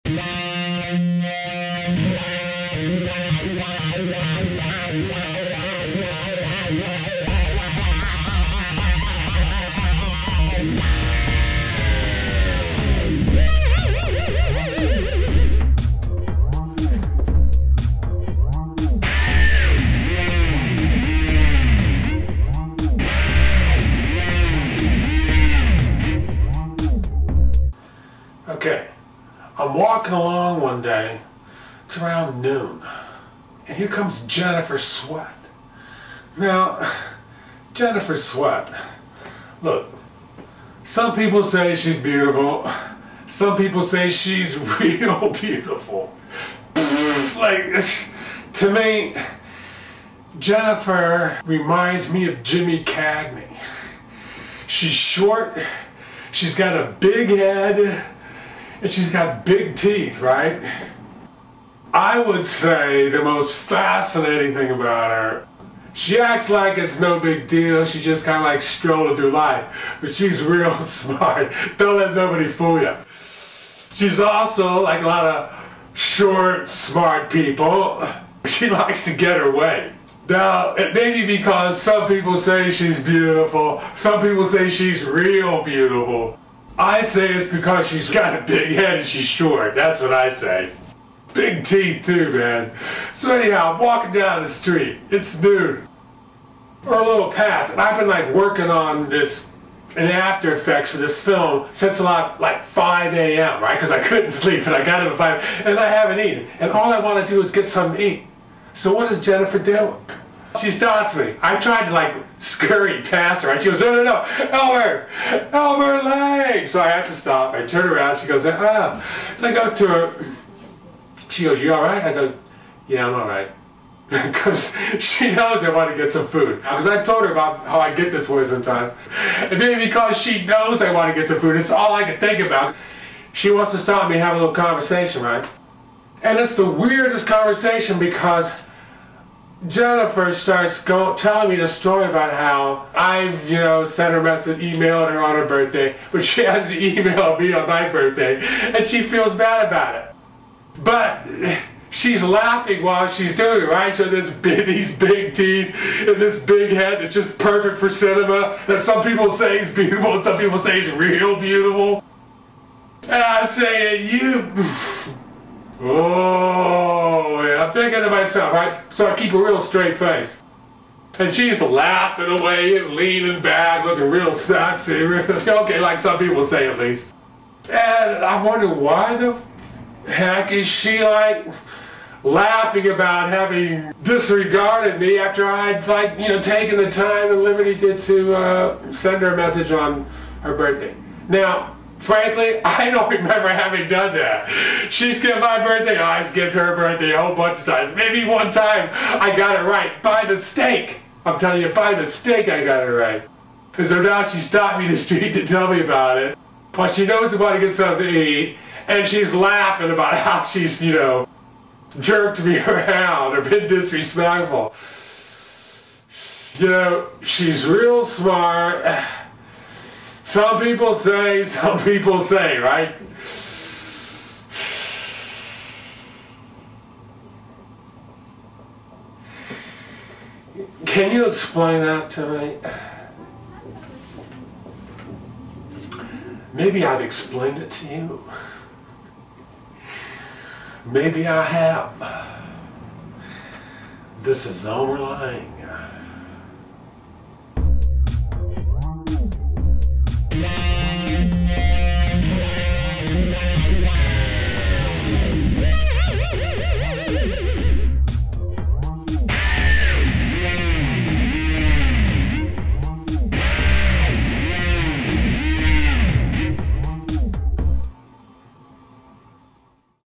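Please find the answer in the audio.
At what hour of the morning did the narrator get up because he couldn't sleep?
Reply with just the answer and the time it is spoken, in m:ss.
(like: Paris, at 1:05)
5 a.m., at 1:42.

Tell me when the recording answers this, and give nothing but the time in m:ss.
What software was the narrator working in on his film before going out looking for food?
1:40.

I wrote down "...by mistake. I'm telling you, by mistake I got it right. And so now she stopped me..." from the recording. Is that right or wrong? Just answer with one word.
right.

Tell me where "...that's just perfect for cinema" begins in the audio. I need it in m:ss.
2:36.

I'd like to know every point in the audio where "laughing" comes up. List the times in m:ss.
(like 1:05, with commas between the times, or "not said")
2:32, 2:51, 3:02, 3:29.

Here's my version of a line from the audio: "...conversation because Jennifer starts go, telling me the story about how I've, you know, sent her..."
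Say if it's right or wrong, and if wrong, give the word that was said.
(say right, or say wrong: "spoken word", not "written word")
right.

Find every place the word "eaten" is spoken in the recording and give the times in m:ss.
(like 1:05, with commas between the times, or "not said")
1:46.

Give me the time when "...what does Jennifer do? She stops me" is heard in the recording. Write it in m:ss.
1:48.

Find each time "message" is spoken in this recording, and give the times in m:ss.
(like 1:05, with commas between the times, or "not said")
2:24, 3:09.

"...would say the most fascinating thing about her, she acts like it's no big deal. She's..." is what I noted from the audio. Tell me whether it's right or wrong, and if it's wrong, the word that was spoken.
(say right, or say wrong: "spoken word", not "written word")
right.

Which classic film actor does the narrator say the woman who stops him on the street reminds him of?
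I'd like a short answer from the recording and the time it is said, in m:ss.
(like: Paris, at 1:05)
Jimmy Cagney, at 0:52.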